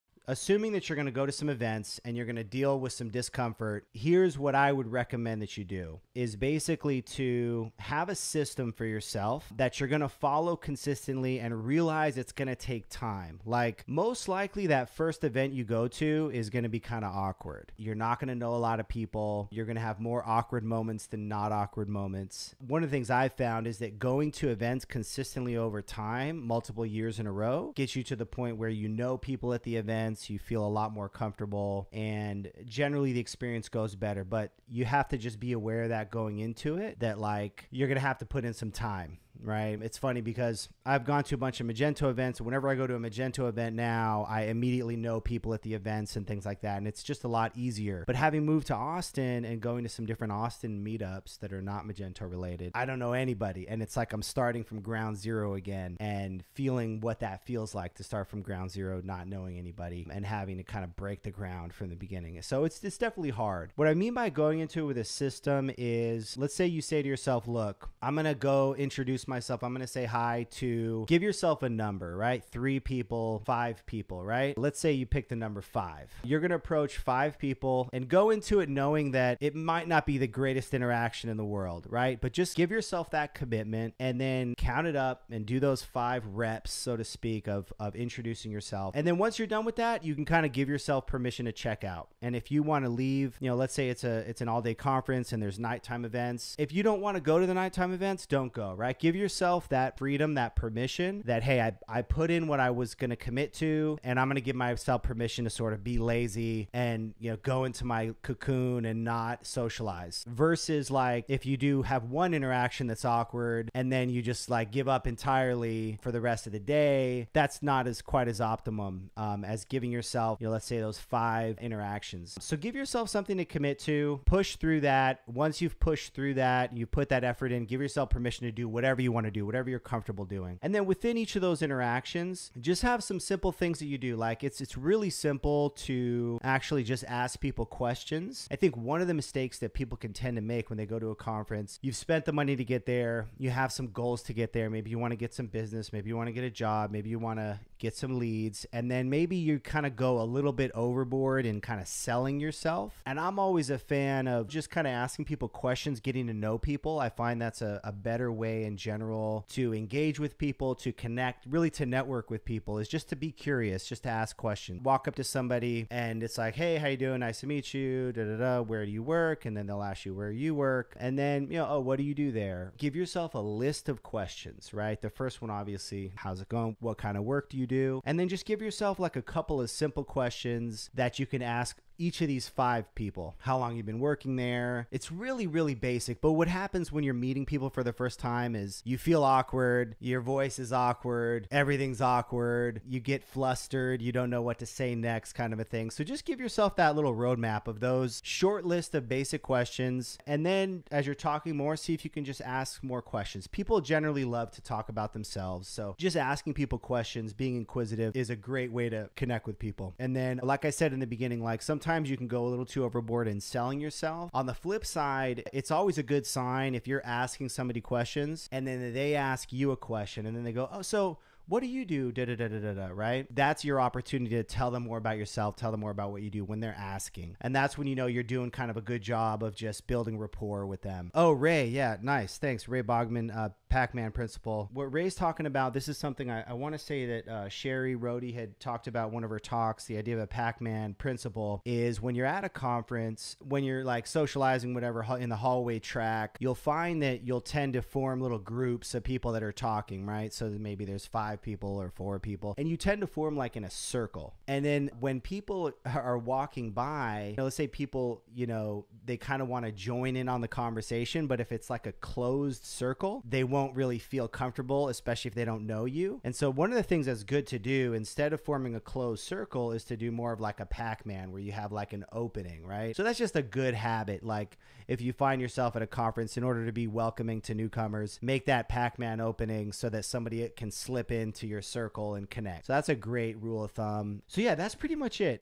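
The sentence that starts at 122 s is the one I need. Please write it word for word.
So give yourself something to commit to, push through that.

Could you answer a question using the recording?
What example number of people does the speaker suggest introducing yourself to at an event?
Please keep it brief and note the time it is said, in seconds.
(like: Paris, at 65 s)
5, at 75 s.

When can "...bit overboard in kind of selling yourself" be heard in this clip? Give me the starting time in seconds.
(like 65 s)
150 s.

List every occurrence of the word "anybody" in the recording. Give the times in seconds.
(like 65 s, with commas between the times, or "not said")
53 s, 59 s.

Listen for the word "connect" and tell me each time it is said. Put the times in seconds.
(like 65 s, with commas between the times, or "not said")
160 s, 209 s, 282 s.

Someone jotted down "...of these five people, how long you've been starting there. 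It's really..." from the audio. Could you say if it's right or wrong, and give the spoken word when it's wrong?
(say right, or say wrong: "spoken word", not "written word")
wrong: "working", not "starting".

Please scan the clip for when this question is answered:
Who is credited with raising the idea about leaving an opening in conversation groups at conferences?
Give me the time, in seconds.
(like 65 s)
232 s.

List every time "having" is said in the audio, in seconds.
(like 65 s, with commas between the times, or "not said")
48 s, 60 s.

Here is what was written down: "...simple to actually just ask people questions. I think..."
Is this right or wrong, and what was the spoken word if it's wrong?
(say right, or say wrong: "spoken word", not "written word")
right.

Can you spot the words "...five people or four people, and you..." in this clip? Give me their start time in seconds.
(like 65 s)
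251 s.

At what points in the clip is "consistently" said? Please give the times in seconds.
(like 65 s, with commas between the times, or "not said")
10 s, 24 s.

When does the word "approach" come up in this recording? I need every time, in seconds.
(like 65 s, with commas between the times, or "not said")
76 s.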